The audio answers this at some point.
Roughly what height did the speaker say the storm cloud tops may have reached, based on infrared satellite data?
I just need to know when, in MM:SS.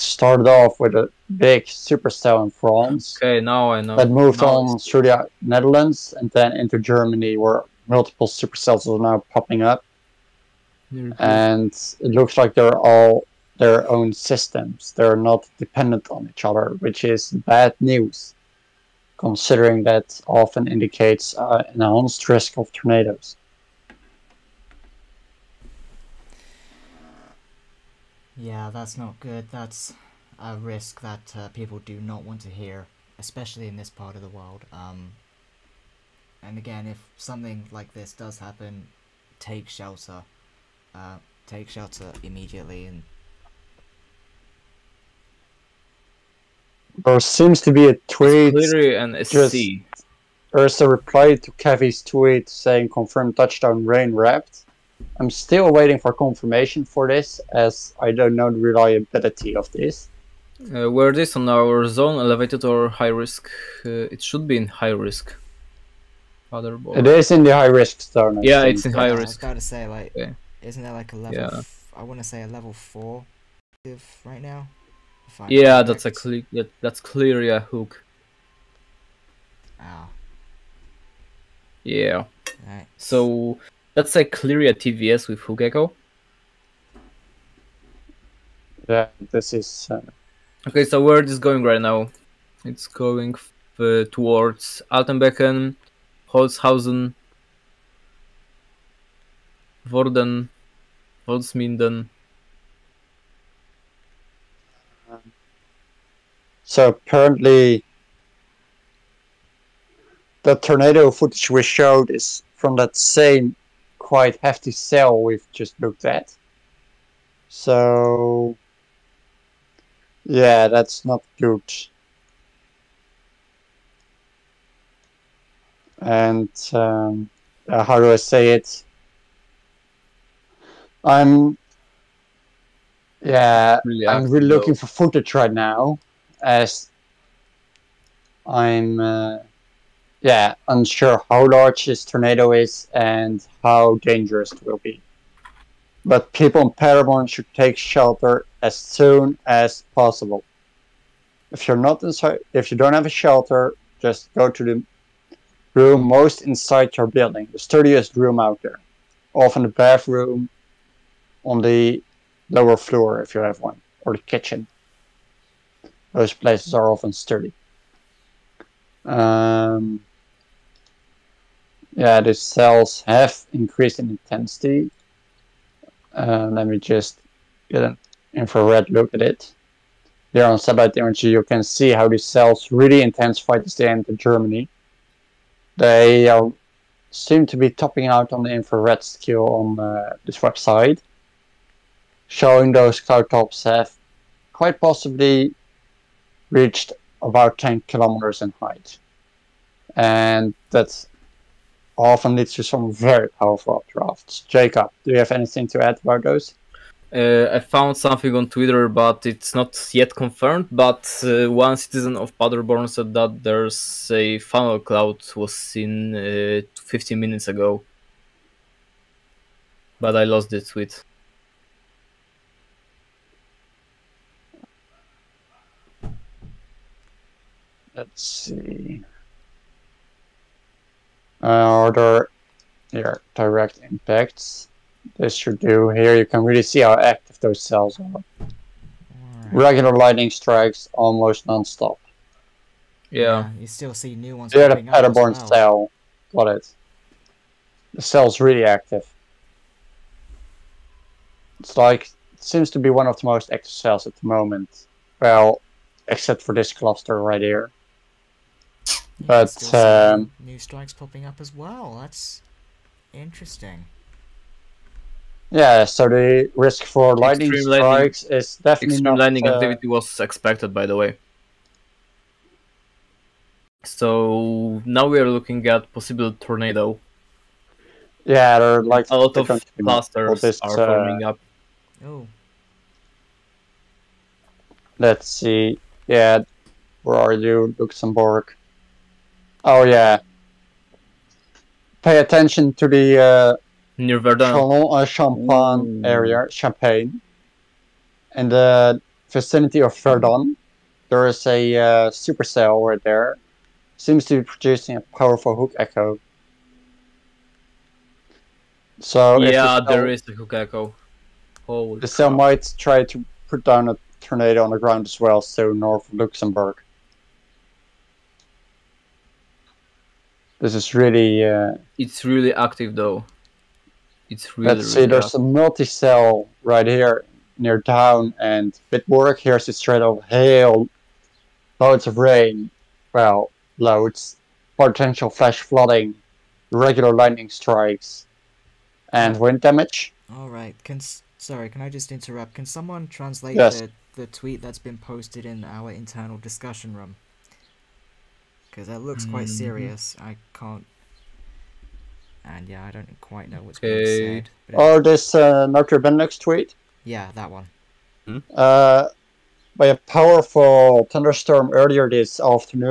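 03:17.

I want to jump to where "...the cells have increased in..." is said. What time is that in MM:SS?
02:52.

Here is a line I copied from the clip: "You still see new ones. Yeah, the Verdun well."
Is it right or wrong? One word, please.
wrong.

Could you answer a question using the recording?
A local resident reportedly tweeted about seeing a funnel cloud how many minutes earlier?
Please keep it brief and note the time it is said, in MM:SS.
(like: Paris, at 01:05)
15, at 03:36.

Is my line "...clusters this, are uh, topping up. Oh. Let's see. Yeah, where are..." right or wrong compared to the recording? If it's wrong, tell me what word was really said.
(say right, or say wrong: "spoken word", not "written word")
wrong: "forming", not "topping".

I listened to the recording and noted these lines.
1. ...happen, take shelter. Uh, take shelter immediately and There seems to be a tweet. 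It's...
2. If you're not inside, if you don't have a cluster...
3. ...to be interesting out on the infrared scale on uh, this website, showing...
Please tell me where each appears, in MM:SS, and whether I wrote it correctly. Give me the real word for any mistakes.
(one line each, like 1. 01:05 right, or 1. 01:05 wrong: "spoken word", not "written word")
1. 00:38 right
2. 02:31 wrong: "shelter", not "cluster"
3. 03:07 wrong: "topping", not "interesting".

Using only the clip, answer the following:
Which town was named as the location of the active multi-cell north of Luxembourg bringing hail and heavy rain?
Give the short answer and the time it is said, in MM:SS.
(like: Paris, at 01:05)
Bitburg, at 05:28.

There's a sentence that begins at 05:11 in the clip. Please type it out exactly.
Holy the cell might try to put down a tornado on the ground as well, so north of Luxembourg.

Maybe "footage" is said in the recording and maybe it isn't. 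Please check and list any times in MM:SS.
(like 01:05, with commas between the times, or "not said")
01:51, 02:14.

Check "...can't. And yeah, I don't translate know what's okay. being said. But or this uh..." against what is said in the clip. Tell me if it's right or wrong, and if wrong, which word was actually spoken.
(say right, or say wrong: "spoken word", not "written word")
wrong: "quite", not "translate".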